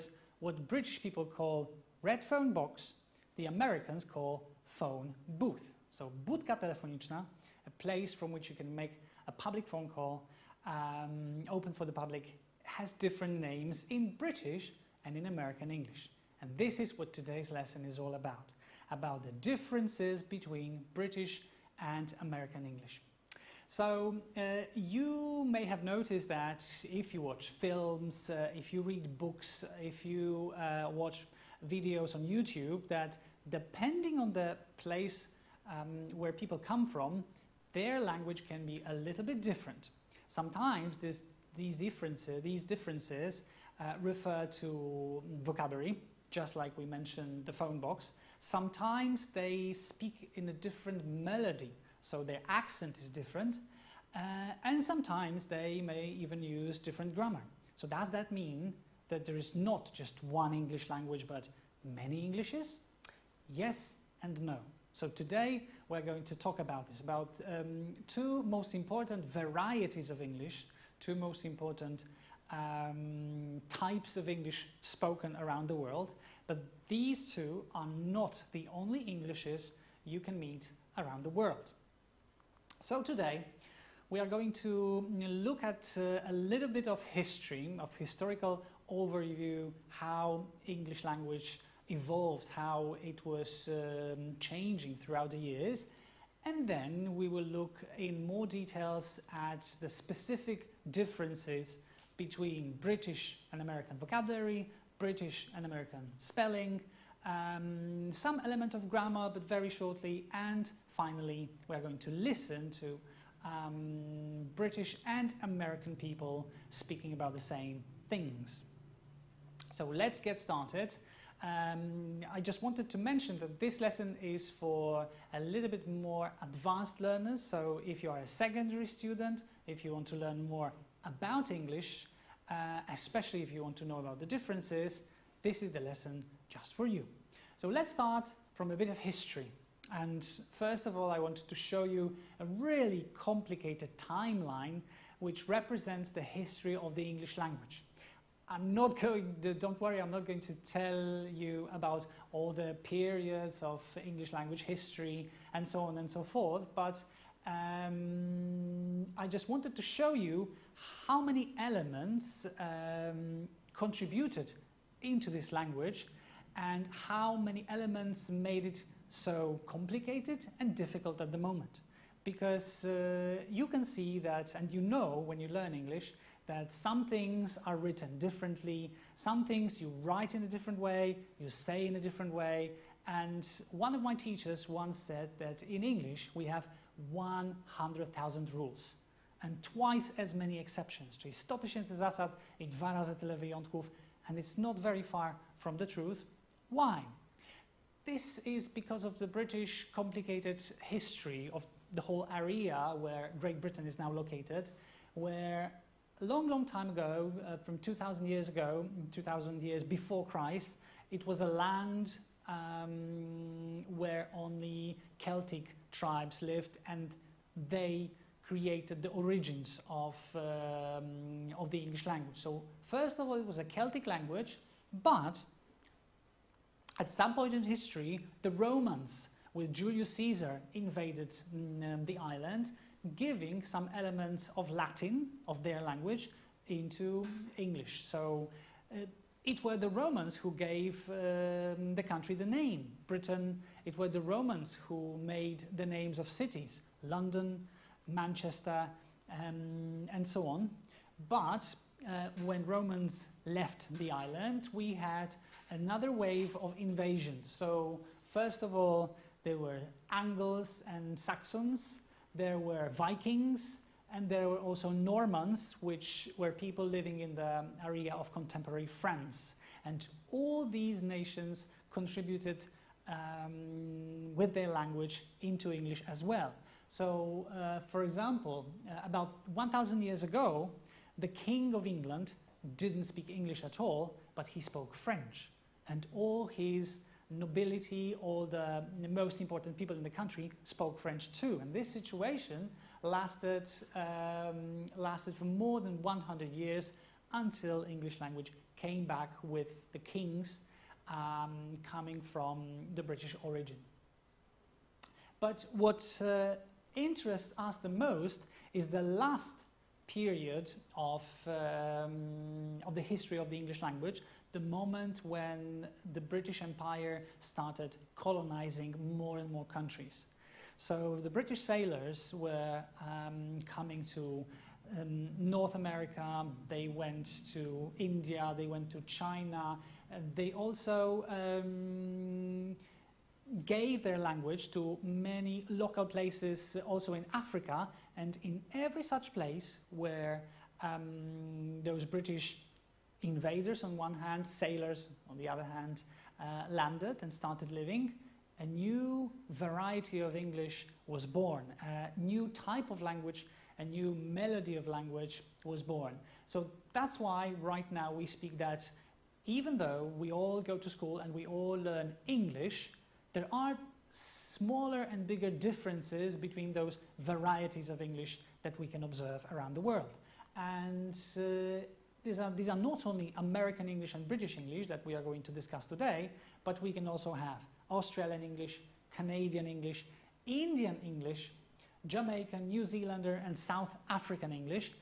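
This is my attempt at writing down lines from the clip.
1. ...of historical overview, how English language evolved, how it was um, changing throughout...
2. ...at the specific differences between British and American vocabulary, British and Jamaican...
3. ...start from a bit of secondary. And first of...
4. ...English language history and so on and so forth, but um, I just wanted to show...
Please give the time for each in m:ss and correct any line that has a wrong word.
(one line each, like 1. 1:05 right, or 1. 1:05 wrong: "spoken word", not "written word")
1. 1:27 right
2. 1:39 wrong: "American", not "Jamaican"
3. 2:17 wrong: "history", not "secondary"
4. 2:34 right.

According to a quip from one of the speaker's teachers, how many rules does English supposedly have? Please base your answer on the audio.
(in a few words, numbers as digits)
100,000.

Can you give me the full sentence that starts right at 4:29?
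And all these nations contributed um, with their language into English as well.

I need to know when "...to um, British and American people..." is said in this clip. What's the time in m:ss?
1:52.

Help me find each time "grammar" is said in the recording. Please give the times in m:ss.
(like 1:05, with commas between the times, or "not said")
0:57, 1:48.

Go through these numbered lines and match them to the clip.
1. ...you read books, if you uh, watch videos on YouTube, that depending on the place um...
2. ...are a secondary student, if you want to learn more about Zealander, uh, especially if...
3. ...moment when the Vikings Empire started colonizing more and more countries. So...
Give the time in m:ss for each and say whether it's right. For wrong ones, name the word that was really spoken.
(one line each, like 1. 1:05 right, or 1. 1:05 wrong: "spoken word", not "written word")
1. 0:28 right
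2. 2:08 wrong: "English", not "Zealander"
3. 5:14 wrong: "British", not "Vikings".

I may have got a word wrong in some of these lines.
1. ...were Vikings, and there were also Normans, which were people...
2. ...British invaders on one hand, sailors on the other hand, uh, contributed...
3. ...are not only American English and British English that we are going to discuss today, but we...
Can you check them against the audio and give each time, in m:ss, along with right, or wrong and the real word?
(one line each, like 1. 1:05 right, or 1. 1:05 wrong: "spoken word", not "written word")
1. 4:22 right
2. 5:42 wrong: "landed", not "contributed"
3. 6:12 right.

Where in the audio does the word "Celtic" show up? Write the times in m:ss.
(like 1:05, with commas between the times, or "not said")
3:35, 3:43.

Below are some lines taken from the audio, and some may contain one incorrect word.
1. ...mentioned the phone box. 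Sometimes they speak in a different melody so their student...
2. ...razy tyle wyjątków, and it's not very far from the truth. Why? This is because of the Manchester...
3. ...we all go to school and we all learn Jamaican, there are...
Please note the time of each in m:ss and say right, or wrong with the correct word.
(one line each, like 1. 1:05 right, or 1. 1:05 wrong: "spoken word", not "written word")
1. 0:46 wrong: "accent", not "student"
2. 3:12 wrong: "British", not "Manchester"
3. 6:00 wrong: "English", not "Jamaican".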